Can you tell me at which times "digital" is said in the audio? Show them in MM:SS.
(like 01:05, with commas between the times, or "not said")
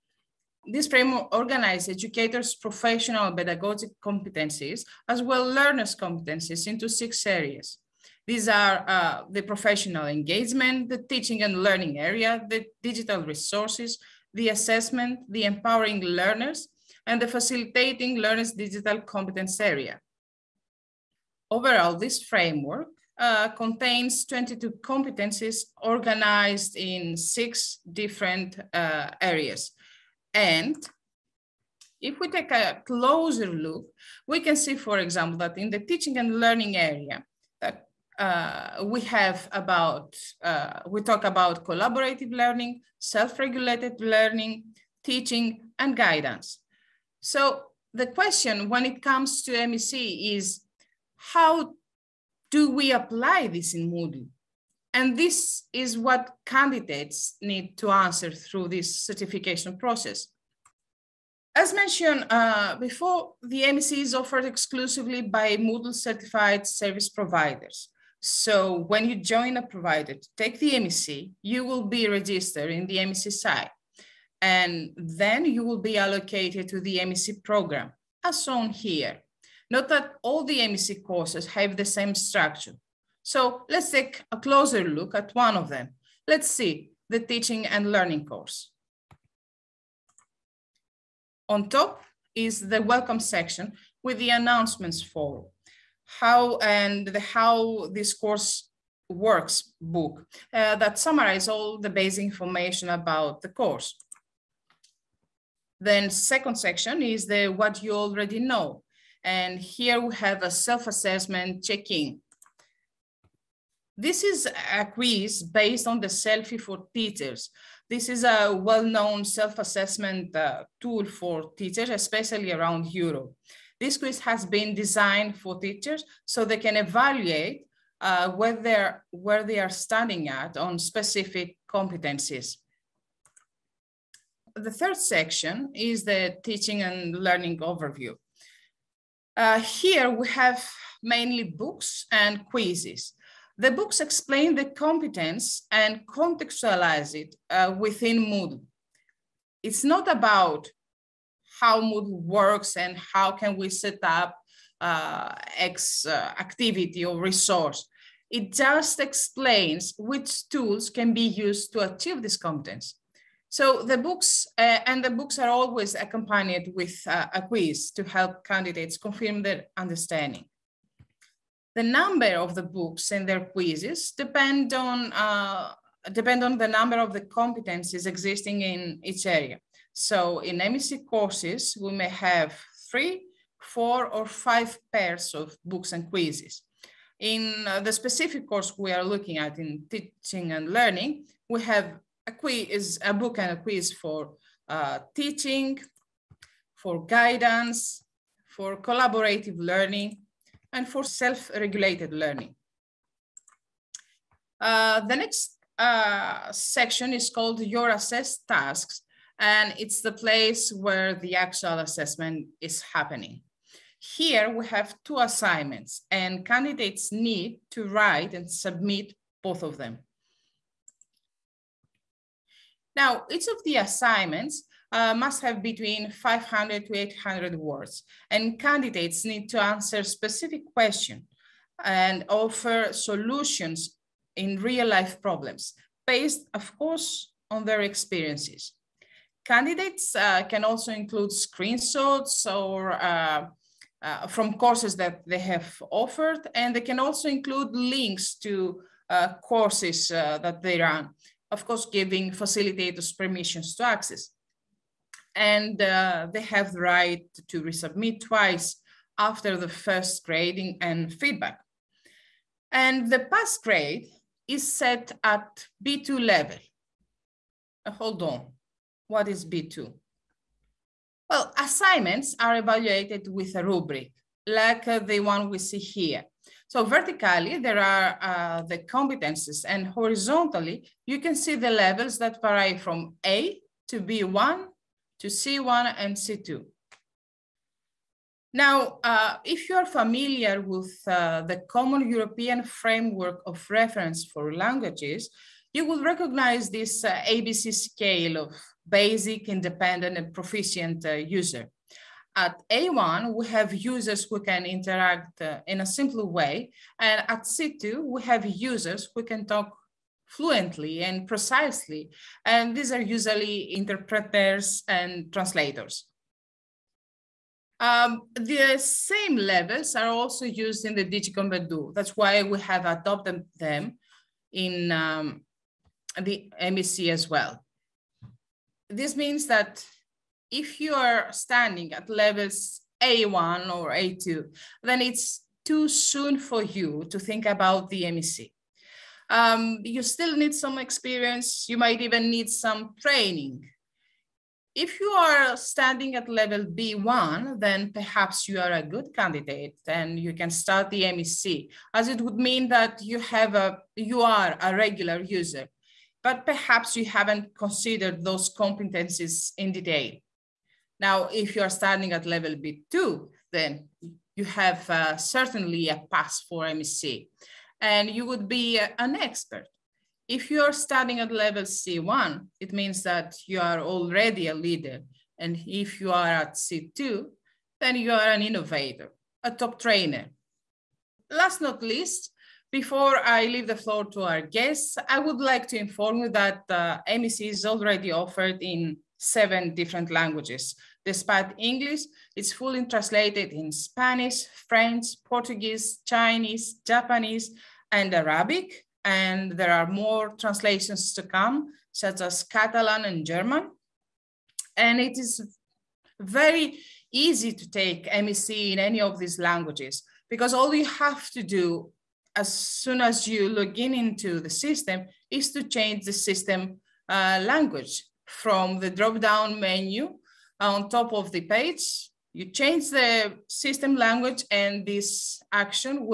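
00:12, 00:18.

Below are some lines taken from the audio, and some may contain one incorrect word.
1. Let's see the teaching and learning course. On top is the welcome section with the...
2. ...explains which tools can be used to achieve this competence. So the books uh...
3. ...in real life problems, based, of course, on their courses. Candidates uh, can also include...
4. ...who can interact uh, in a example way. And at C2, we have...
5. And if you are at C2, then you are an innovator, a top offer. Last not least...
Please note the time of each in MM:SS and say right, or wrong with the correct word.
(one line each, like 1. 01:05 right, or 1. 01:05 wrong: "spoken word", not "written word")
1. 01:26 right
2. 02:38 right
3. 03:54 wrong: "experiences", not "courses"
4. 05:04 wrong: "simple", not "example"
5. 06:15 wrong: "trainer", not "offer".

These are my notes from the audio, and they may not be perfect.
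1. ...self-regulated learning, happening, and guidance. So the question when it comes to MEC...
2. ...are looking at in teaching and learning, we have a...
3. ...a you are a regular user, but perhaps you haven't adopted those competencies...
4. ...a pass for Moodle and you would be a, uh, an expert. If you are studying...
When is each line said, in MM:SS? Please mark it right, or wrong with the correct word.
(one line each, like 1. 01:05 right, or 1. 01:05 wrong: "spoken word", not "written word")
1. 00:42 wrong: "teaching", not "happening"
2. 03:08 right
3. 05:53 wrong: "considered", not "adopted"
4. 06:05 wrong: "MEC", not "Moodle".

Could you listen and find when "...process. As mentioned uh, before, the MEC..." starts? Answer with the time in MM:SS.
00:59.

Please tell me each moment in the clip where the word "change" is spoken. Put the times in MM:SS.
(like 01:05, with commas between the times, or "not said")
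06:55, 07:02.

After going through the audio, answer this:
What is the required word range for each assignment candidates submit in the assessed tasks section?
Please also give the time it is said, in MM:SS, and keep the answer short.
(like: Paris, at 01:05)
500 to 800 words, at 03:46.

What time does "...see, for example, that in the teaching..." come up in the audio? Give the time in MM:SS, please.
00:34.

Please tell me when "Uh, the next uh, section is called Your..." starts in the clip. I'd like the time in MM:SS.
03:24.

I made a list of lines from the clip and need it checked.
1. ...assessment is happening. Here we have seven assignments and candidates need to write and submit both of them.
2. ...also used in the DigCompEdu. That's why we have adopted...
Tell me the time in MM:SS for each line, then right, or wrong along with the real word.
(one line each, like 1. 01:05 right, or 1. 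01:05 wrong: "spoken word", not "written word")
1. 03:31 wrong: "two", not "seven"
2. 05:20 right.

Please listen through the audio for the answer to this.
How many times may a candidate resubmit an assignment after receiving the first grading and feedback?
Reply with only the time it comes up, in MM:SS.
04:18.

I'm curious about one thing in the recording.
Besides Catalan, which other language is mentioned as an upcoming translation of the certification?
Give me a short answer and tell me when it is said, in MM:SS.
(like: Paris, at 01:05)
German, at 06:43.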